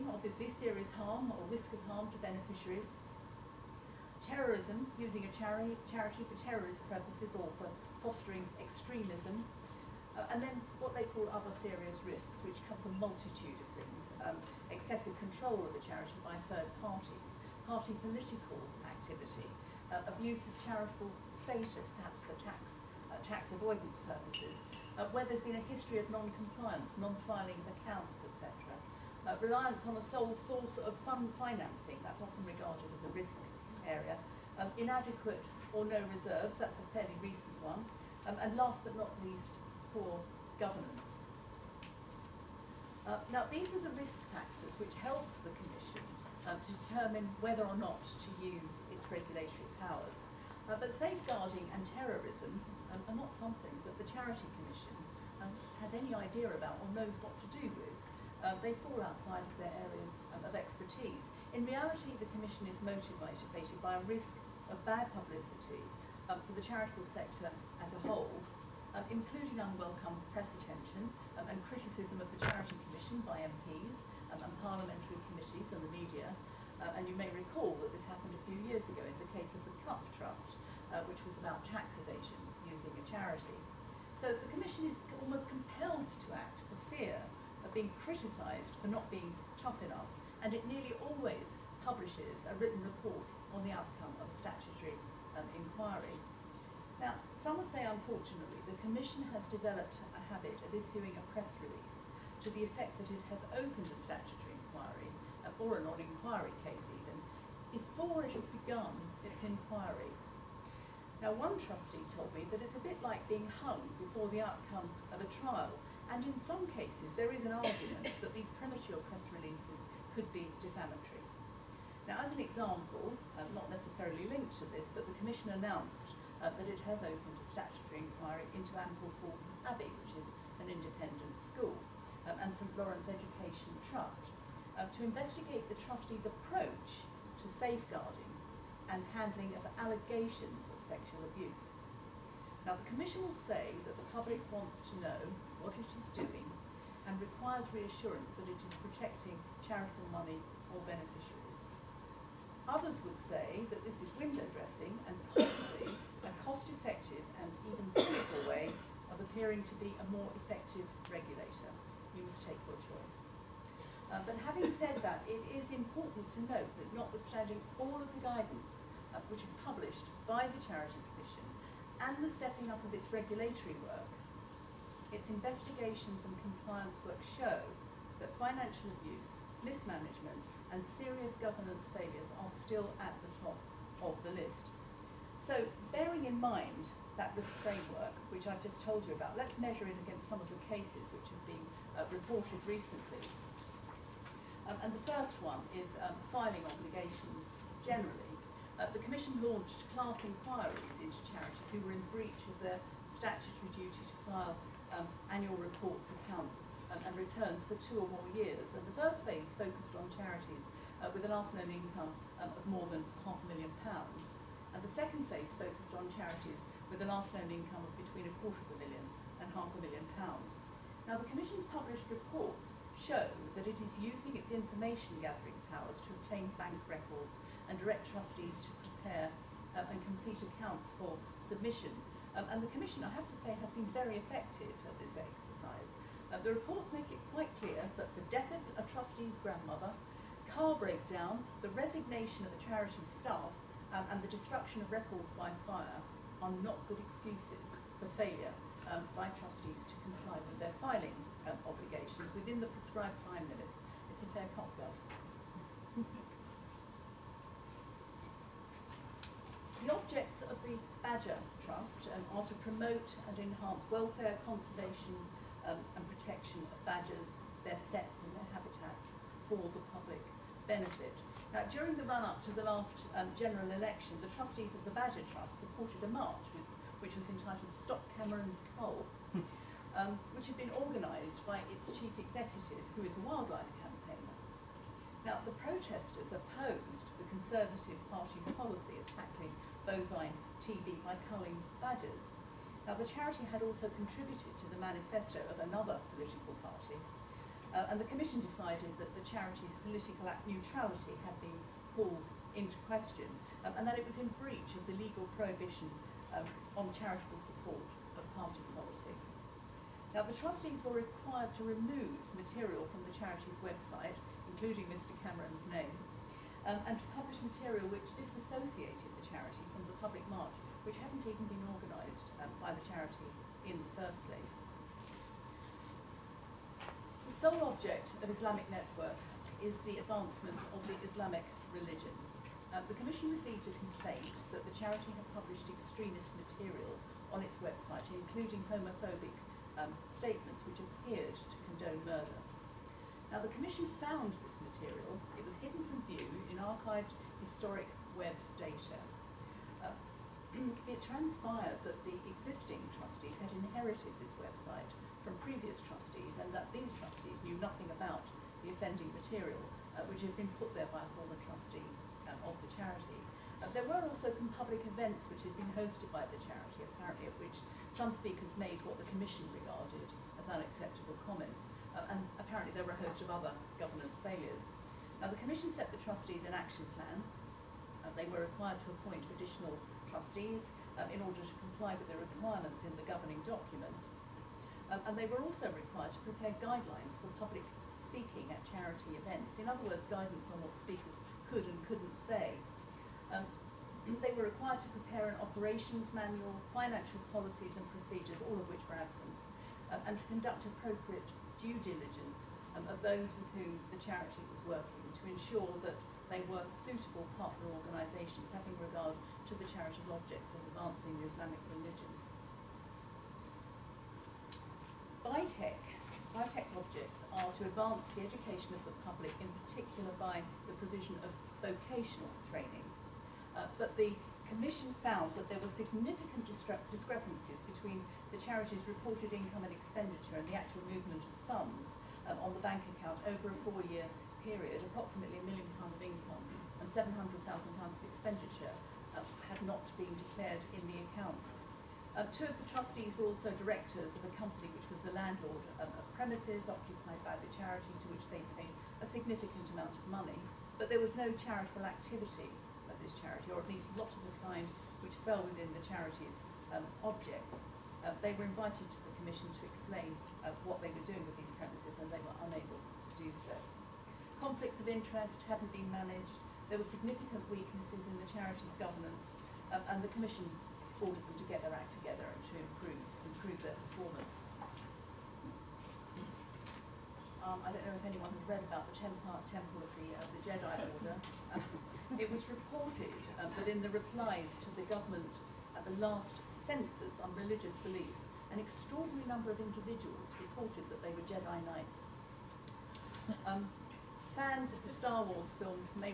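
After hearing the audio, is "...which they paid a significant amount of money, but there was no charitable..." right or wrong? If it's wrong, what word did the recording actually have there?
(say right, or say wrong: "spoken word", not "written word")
right.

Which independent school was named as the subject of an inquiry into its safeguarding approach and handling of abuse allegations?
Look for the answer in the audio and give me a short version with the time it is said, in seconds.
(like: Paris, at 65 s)
Ampleforth Abbey, at 128 s.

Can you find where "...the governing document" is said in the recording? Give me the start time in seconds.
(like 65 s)
382 s.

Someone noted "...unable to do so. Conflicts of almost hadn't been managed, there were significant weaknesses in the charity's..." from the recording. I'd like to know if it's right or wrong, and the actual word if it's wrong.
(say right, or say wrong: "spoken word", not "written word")
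wrong: "interest", not "almost".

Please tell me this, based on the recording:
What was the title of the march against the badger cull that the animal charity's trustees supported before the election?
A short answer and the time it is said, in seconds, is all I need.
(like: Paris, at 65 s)
Stop Cameron's Cull, at 277 s.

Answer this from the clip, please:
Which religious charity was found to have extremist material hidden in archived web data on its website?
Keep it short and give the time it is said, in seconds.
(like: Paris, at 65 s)
Islamic Network, at 328 s.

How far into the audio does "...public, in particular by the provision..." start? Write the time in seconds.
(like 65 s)
419 s.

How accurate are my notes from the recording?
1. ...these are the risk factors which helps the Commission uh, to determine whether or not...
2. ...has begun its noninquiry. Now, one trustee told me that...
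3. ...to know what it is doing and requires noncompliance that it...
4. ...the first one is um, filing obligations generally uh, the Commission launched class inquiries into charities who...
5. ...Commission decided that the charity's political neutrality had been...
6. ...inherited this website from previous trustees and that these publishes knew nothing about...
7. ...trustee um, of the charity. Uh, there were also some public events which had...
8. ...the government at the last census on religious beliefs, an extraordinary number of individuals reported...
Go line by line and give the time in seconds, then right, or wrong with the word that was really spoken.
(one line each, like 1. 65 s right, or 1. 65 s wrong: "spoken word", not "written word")
1. 43 s right
2. 108 s wrong: "inquiry", not "noninquiry"
3. 144 s wrong: "reassurance", not "noncompliance"
4. 194 s right
5. 298 s right
6. 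353 s wrong: "trustees", not "publishes"
7. 361 s right
8. 484 s right.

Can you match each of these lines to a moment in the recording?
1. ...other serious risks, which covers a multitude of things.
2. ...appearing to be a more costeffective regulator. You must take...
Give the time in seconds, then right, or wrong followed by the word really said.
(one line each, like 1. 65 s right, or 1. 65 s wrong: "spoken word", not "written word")
1. 11 s right
2. 159 s wrong: "effective", not "costeffective".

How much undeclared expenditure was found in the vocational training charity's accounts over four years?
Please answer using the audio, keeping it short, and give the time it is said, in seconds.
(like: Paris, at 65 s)
700,000 pounds, at 436 s.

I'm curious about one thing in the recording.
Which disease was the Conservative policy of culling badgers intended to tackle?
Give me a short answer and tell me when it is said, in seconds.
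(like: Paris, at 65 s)
bovine TB, at 289 s.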